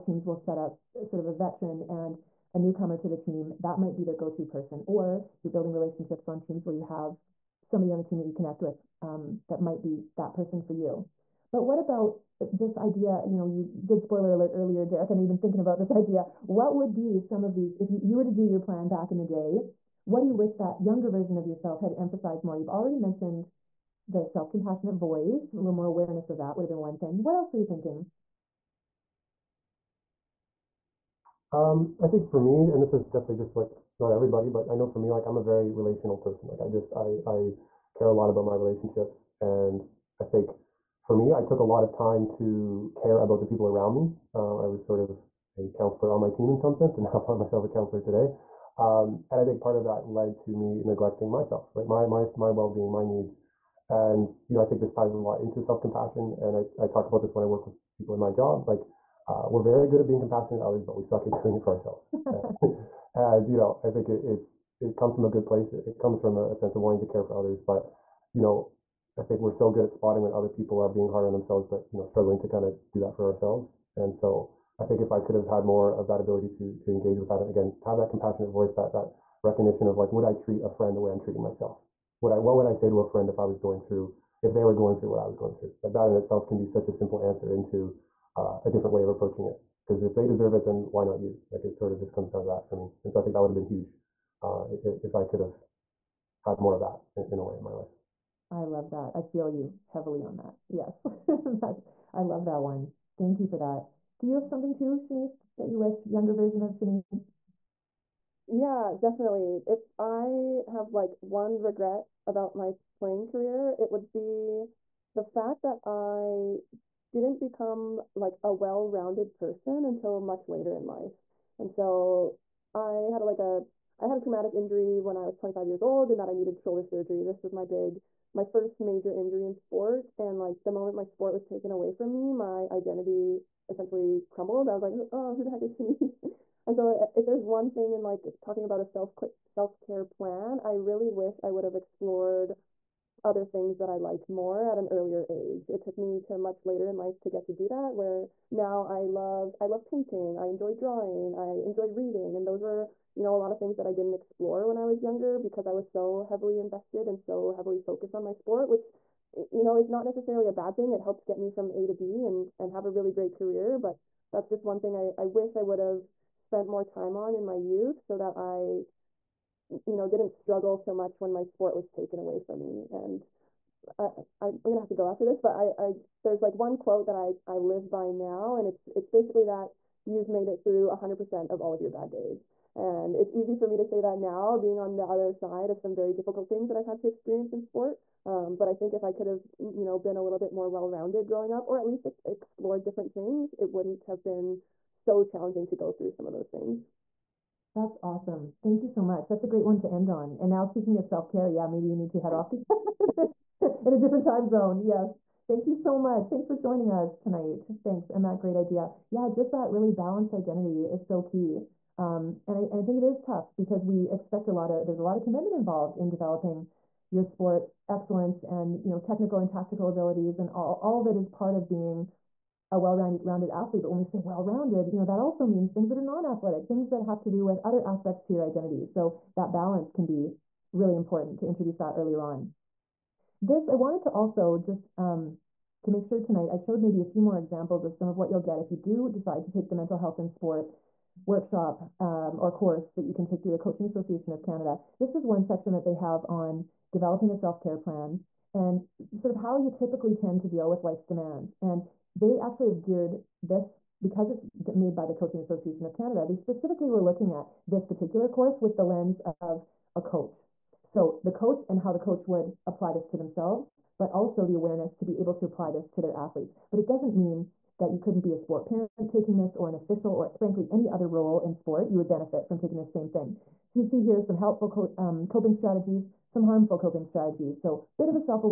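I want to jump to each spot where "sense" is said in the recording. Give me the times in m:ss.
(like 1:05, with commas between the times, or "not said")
0:46, 1:06.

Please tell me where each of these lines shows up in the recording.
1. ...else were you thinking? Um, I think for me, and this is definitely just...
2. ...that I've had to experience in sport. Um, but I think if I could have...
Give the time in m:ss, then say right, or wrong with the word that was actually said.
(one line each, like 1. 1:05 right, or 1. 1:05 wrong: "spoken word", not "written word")
1. 0:27 right
2. 3:06 right.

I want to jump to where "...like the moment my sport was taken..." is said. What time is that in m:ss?
2:10.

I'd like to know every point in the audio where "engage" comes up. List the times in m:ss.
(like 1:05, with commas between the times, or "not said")
1:16.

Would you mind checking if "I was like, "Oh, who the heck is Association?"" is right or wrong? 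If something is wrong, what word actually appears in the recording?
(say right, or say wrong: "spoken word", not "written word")
wrong: "Shanice", not "Association".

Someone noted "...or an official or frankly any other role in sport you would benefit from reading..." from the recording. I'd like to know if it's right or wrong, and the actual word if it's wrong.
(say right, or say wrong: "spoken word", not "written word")
wrong: "taking", not "reading".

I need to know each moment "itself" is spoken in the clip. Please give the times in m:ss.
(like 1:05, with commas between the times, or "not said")
1:26.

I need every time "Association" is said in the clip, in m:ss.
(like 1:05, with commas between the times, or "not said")
4:03, 4:15.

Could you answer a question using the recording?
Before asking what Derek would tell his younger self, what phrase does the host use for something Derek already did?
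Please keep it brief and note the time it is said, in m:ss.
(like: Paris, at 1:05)
spoiler alert, at 0:14.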